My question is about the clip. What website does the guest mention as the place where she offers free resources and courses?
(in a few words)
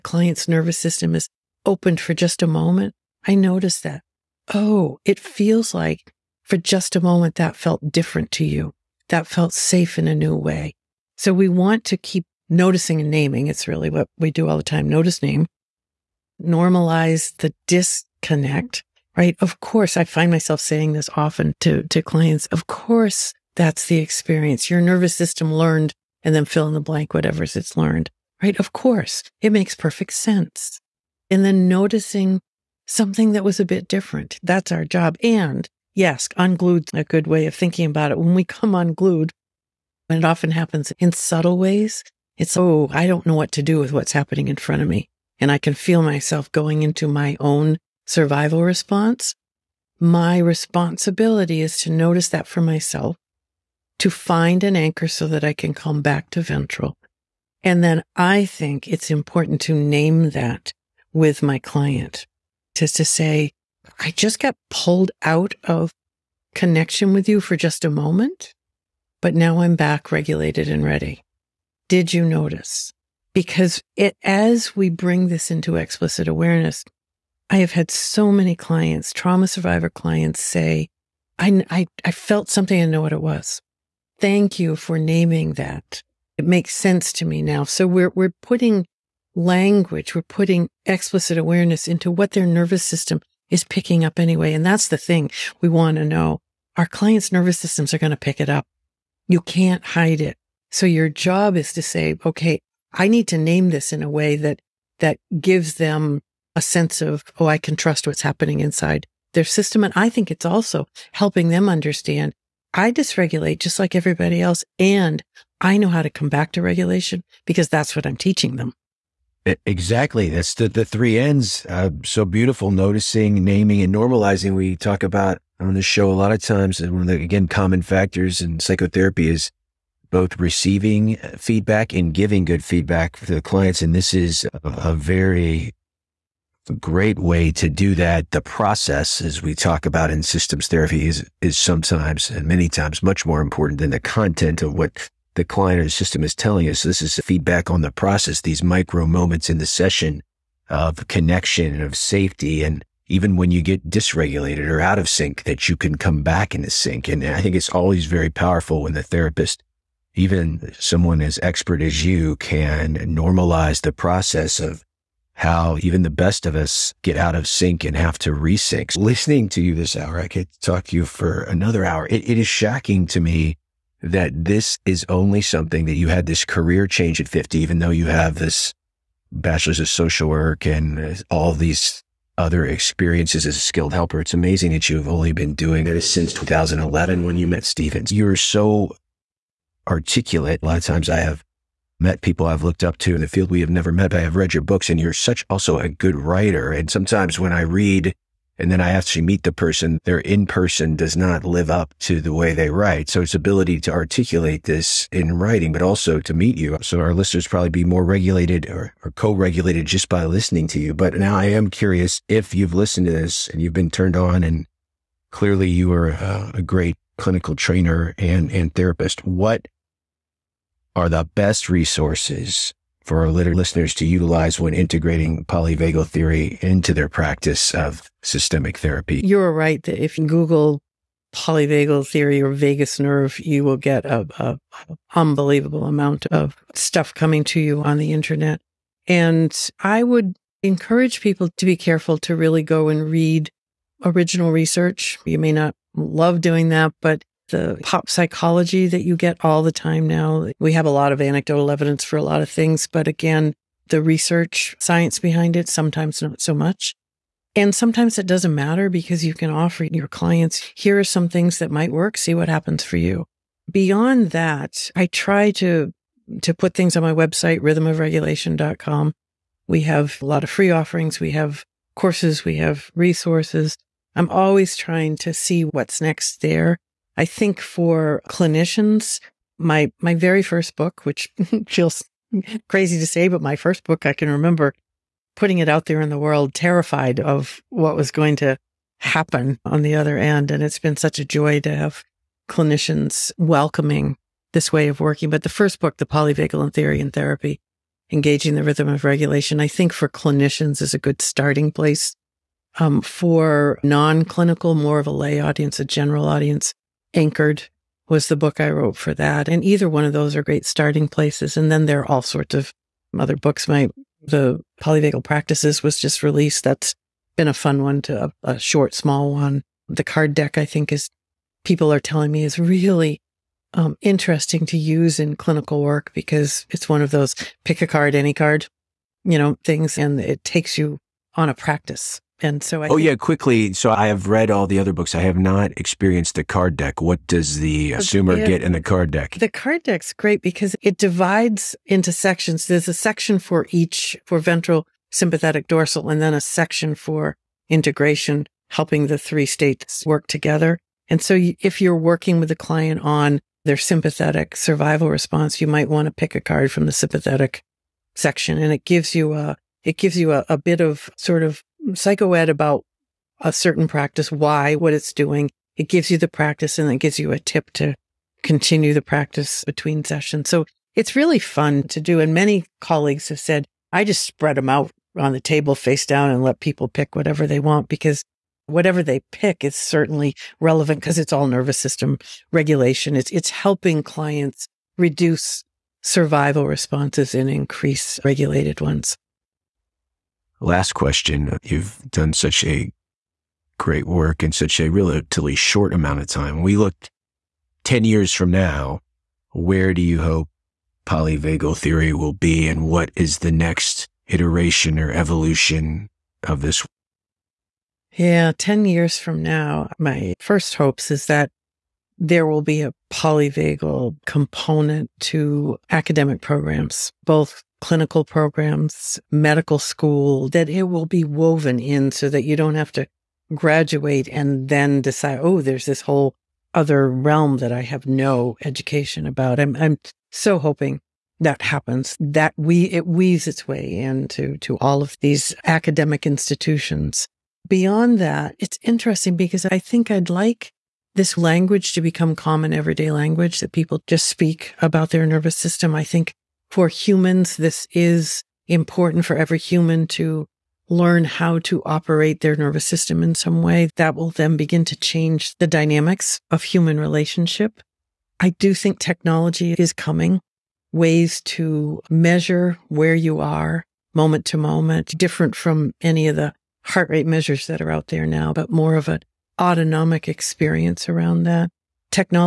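rhythmofregulation.com.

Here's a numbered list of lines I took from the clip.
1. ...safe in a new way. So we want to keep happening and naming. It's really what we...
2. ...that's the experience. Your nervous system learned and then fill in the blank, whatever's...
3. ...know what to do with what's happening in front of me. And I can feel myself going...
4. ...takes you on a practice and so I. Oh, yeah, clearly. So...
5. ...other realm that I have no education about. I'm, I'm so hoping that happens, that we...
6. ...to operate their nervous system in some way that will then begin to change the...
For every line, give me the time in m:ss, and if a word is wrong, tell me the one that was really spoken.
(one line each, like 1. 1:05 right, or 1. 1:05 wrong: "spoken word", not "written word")
1. 0:09 wrong: "noticing", not "happening"
2. 0:23 right
3. 0:43 right
4. 5:30 wrong: "quickly", not "clearly"
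5. 7:06 right
6. 7:31 right.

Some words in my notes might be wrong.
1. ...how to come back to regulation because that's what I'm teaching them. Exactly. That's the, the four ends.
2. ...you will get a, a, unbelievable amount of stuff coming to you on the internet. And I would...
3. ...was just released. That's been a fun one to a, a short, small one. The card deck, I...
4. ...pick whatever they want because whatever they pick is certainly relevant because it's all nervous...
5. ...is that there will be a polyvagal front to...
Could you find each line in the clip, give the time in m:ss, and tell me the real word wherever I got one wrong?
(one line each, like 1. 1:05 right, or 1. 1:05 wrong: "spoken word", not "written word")
1. 1:55 wrong: "three", not "four"
2. 3:53 right
3. 5:15 right
4. 6:16 right
5. 6:51 wrong: "component", not "front".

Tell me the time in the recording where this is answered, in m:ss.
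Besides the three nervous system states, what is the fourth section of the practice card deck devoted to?
5:47.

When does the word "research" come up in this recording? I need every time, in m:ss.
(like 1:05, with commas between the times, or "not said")
4:04, 4:14.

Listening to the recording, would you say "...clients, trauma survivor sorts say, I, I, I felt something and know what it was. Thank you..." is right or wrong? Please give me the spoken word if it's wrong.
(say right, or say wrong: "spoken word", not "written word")
wrong: "clients", not "sorts".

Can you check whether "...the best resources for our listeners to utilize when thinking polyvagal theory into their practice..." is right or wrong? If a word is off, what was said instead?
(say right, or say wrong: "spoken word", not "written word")
wrong: "integrating", not "thinking".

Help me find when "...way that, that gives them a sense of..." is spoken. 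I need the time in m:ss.
1:44.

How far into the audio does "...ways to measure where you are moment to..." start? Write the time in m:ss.
7:40.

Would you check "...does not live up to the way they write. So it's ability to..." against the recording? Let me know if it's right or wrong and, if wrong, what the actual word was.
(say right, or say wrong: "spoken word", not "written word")
right.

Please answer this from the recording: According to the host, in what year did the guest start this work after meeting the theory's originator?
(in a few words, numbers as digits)
2011.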